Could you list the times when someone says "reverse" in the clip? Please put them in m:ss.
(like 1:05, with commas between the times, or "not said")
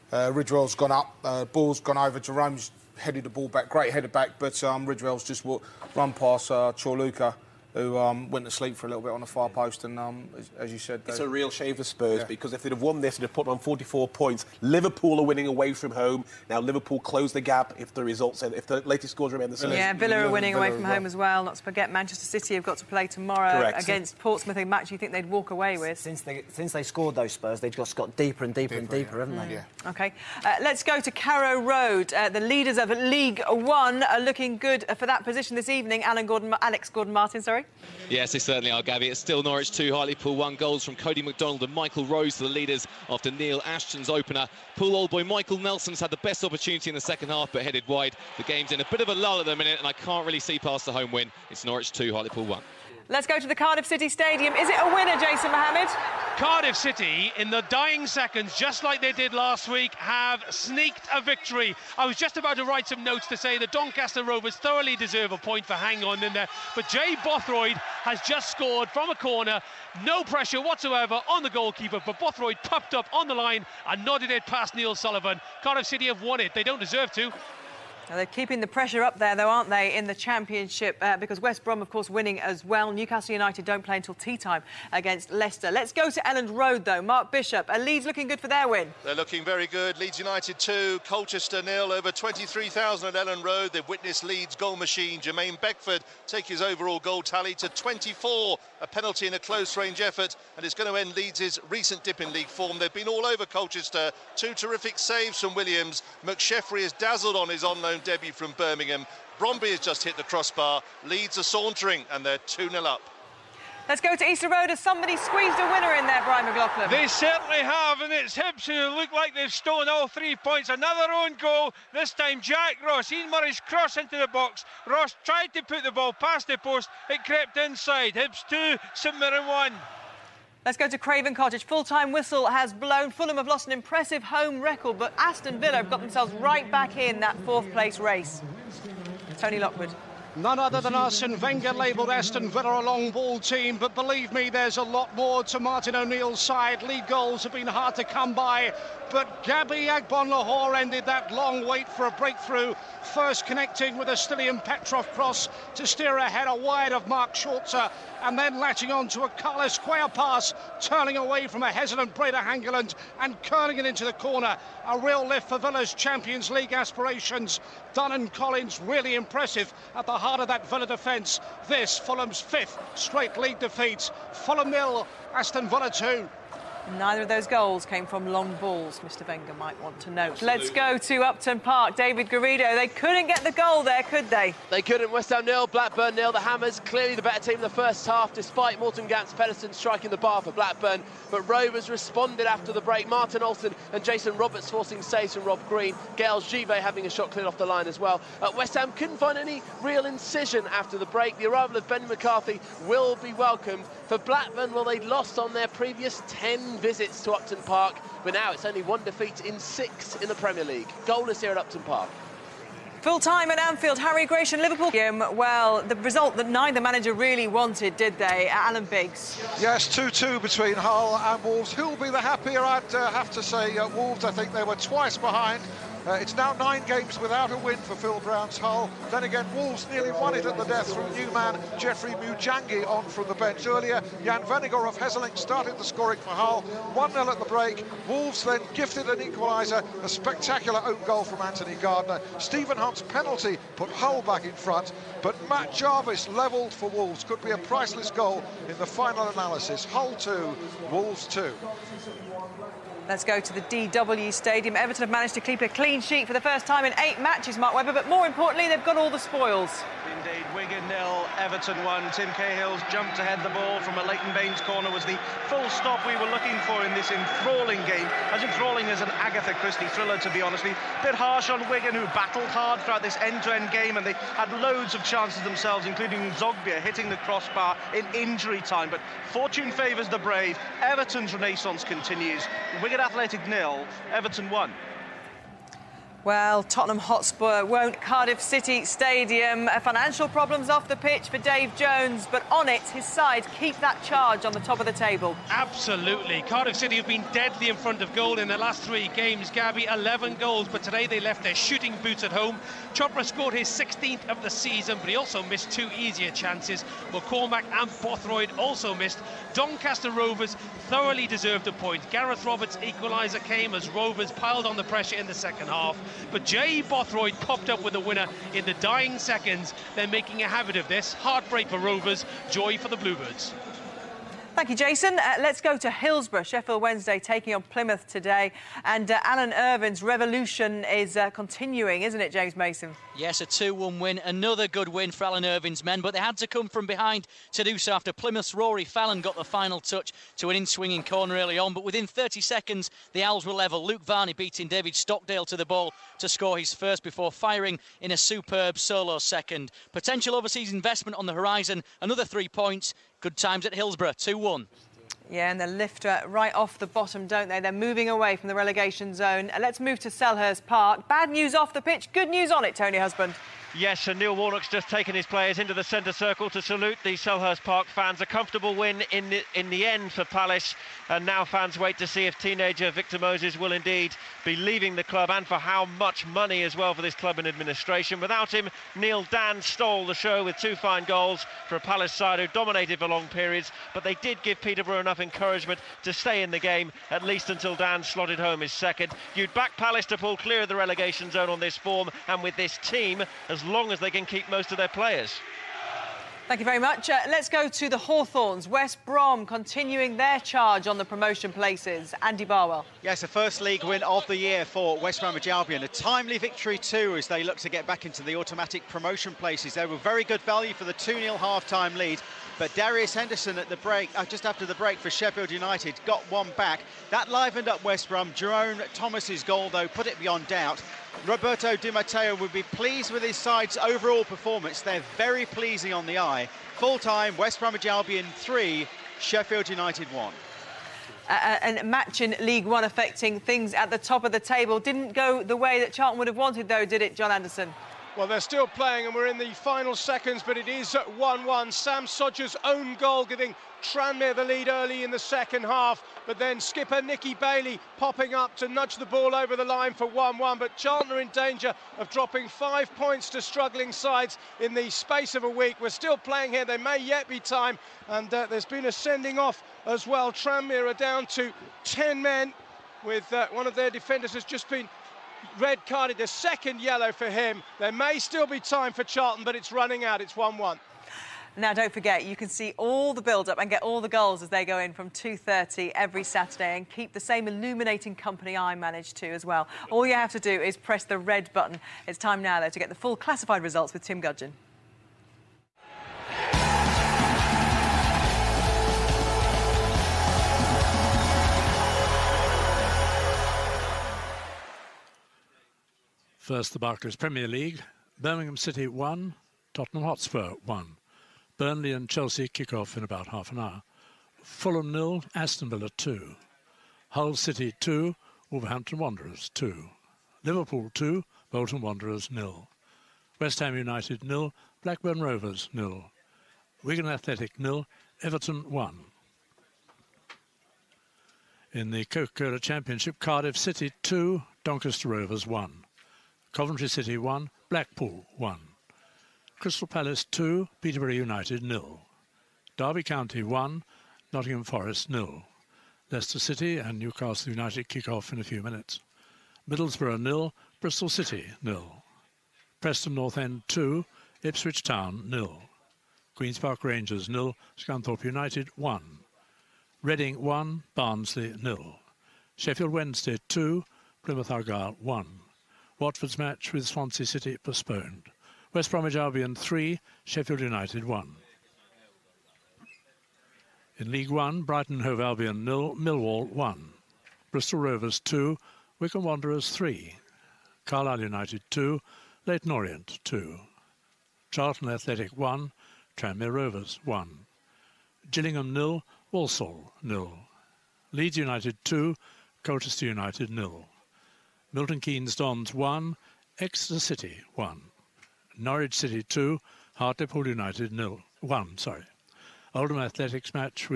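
not said.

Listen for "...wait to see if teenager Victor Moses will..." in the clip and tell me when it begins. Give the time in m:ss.
6:11.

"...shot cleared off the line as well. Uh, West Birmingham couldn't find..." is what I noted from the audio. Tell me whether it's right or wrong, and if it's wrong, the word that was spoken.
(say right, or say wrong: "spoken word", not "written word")
wrong: "Ham", not "Birmingham".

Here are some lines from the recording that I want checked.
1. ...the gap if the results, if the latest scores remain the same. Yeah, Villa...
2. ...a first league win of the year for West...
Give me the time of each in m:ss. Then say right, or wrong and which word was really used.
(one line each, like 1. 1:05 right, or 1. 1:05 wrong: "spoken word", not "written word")
1. 0:17 right
2. 6:43 right.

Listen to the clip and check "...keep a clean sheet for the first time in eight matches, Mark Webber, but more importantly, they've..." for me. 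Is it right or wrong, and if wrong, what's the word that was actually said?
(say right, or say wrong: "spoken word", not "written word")
right.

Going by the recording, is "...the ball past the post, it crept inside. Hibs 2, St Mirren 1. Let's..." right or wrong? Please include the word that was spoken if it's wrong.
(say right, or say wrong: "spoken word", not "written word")
right.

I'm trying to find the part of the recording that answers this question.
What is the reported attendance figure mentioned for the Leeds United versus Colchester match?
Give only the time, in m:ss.
1:31.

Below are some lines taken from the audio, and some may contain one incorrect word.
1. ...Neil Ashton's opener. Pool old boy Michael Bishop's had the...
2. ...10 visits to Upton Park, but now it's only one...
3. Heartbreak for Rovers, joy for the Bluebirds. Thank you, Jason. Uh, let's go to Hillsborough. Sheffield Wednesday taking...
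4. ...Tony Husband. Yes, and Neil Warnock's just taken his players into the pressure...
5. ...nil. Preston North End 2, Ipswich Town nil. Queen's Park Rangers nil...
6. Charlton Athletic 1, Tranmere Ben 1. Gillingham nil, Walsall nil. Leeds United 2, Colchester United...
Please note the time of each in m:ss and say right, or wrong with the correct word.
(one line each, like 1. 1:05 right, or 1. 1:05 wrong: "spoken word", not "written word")
1. 0:43 wrong: "Nelson", not "Bishop"
2. 3:26 right
3. 5:21 right
4. 6:02 wrong: "centre", not "pressure"
5. 9:01 right
6. 9:34 wrong: "Rovers", not "Ben".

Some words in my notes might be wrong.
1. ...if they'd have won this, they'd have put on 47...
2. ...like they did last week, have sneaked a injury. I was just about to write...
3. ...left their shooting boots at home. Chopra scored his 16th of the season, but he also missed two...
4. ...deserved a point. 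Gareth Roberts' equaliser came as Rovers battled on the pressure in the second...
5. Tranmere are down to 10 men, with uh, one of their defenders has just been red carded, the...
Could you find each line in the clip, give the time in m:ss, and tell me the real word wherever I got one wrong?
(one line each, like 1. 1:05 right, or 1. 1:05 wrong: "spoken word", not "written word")
1. 0:12 wrong: "44", not "47"
2. 0:58 wrong: "victory", not "injury"
3. 5:01 right
4. 5:11 wrong: "piled", not "battled"
5. 7:40 right.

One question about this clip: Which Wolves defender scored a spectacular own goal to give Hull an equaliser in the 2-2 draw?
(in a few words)
Anthony Gardner.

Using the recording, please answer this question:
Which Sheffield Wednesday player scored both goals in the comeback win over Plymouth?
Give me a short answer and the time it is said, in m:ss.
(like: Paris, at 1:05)
Luke Varney, at 5:43.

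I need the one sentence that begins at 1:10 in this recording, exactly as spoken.
No pressure whatsoever on the goalkeeper, but Bothroyd popped up on the line and nodded it past Neil Sullivan.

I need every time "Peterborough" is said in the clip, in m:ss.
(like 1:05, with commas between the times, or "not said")
6:24, 8:50.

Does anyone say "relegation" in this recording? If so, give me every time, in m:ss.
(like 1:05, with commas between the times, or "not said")
5:58, 6:30.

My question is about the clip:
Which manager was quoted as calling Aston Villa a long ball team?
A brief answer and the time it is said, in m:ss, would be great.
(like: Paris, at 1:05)
Arsene Wenger, at 2:20.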